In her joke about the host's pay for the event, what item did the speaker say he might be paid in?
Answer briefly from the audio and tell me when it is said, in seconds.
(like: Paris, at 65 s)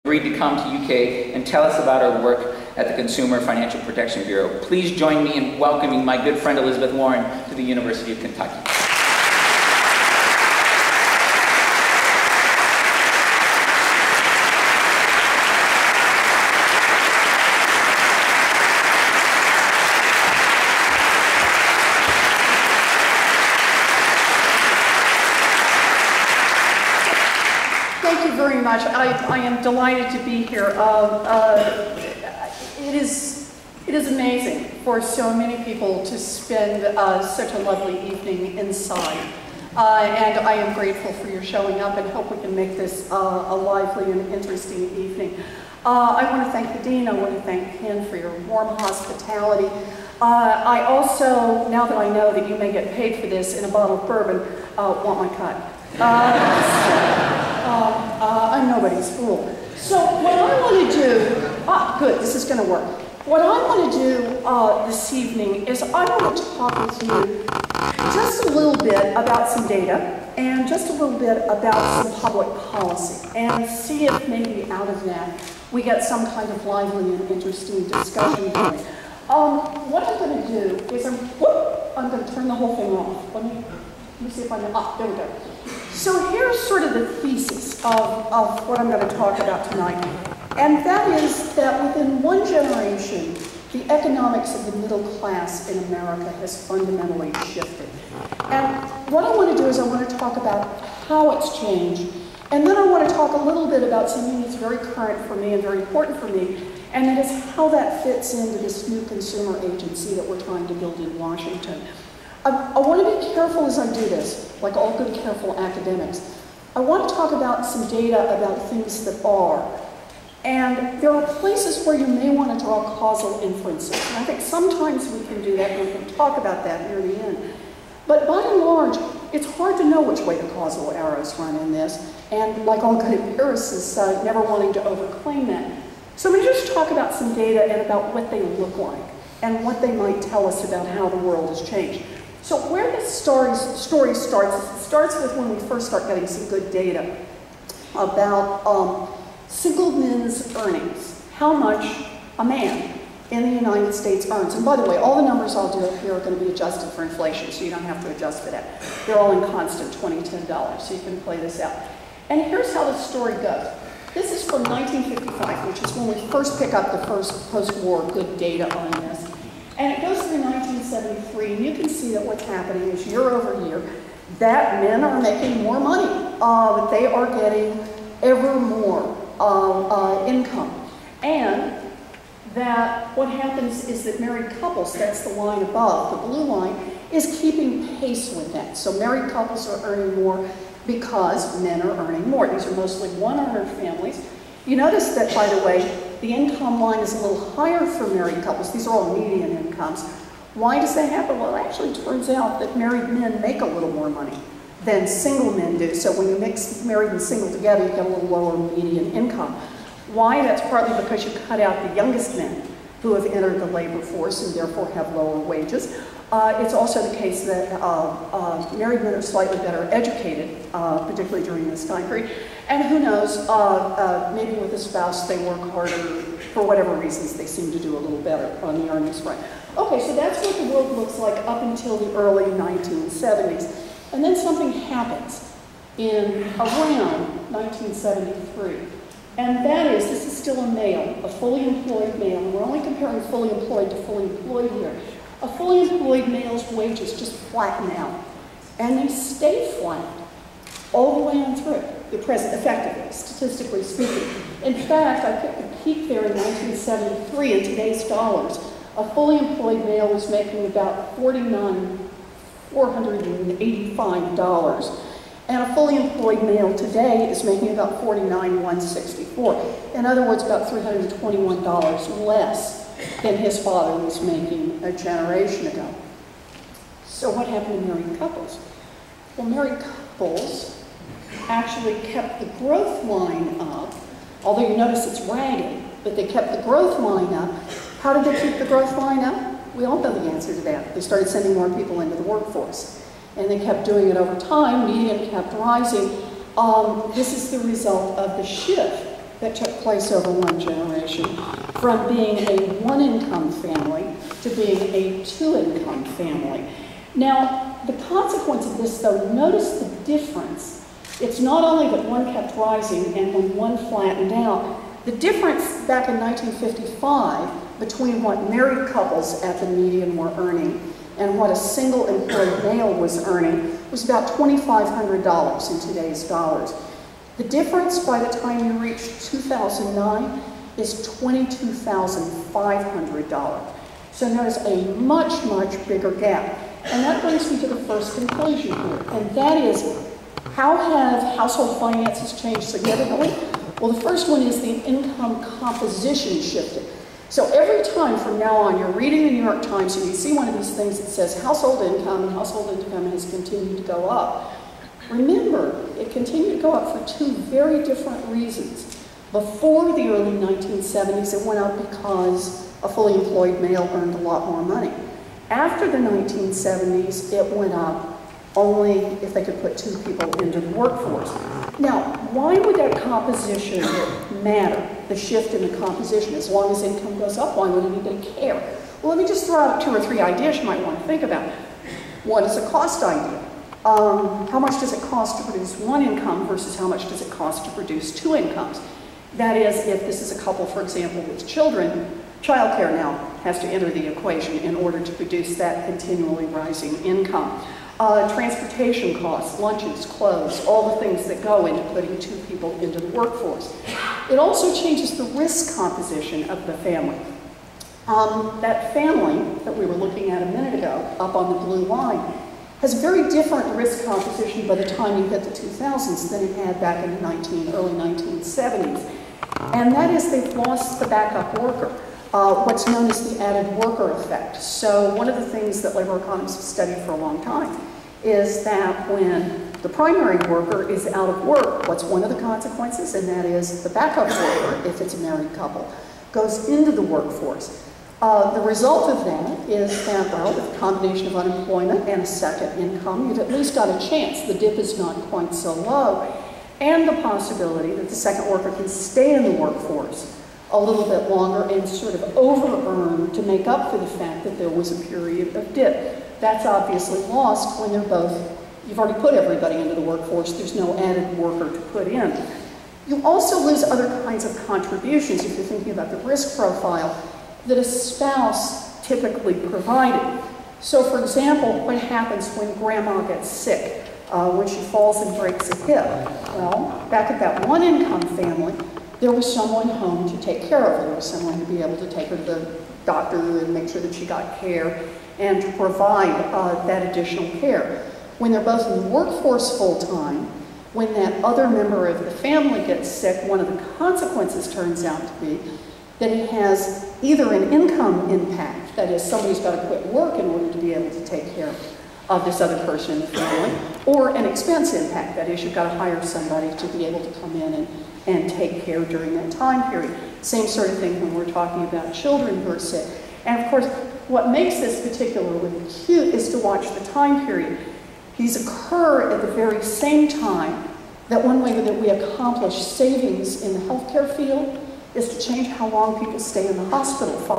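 a bottle of bourbon, at 53 s.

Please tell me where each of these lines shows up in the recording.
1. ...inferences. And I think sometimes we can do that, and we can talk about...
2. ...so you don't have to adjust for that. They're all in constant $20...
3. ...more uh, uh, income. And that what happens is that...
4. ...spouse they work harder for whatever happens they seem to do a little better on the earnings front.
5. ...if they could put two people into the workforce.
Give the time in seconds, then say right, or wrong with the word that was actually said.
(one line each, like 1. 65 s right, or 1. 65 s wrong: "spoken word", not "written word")
1. 123 s right
2. 157 s right
3. 178 s right
4. 224 s wrong: "reasons", not "happens"
5. 369 s right.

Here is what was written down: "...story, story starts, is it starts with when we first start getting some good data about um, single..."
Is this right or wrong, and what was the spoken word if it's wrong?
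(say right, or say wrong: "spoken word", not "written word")
right.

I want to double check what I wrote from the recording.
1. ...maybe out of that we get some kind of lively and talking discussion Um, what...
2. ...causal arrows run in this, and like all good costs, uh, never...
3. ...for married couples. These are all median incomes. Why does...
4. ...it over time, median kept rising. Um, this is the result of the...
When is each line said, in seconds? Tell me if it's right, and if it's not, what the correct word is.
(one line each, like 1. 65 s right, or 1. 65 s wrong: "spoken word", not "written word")
1. 74 s wrong: "interesting", not "talking"
2. 130 s wrong: "empiricists", not "costs"
3. 197 s right
4. 294 s right.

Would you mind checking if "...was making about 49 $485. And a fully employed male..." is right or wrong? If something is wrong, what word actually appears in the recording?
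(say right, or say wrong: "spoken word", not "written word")
right.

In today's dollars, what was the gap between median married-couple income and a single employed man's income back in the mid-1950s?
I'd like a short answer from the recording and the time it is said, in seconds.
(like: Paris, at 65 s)
$2,500, at 324 s.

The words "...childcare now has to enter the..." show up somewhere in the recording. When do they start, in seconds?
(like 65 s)
392 s.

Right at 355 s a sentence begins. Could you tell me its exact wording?
Remember, it continued to go up for two very different reasons.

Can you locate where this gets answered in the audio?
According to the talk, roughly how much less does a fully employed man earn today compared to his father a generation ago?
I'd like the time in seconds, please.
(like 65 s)
270 s.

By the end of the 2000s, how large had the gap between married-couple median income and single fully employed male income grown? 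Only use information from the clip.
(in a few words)
$22,500.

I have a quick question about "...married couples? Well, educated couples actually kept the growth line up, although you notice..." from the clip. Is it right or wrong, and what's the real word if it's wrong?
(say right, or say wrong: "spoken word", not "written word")
wrong: "married", not "educated".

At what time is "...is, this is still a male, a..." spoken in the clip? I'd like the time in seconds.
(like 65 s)
239 s.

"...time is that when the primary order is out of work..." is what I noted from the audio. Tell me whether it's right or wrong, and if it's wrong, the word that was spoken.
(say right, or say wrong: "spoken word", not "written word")
wrong: "worker", not "order".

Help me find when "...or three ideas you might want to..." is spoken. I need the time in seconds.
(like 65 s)
379 s.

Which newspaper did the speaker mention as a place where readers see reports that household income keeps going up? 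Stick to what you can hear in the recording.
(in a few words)
New York Times.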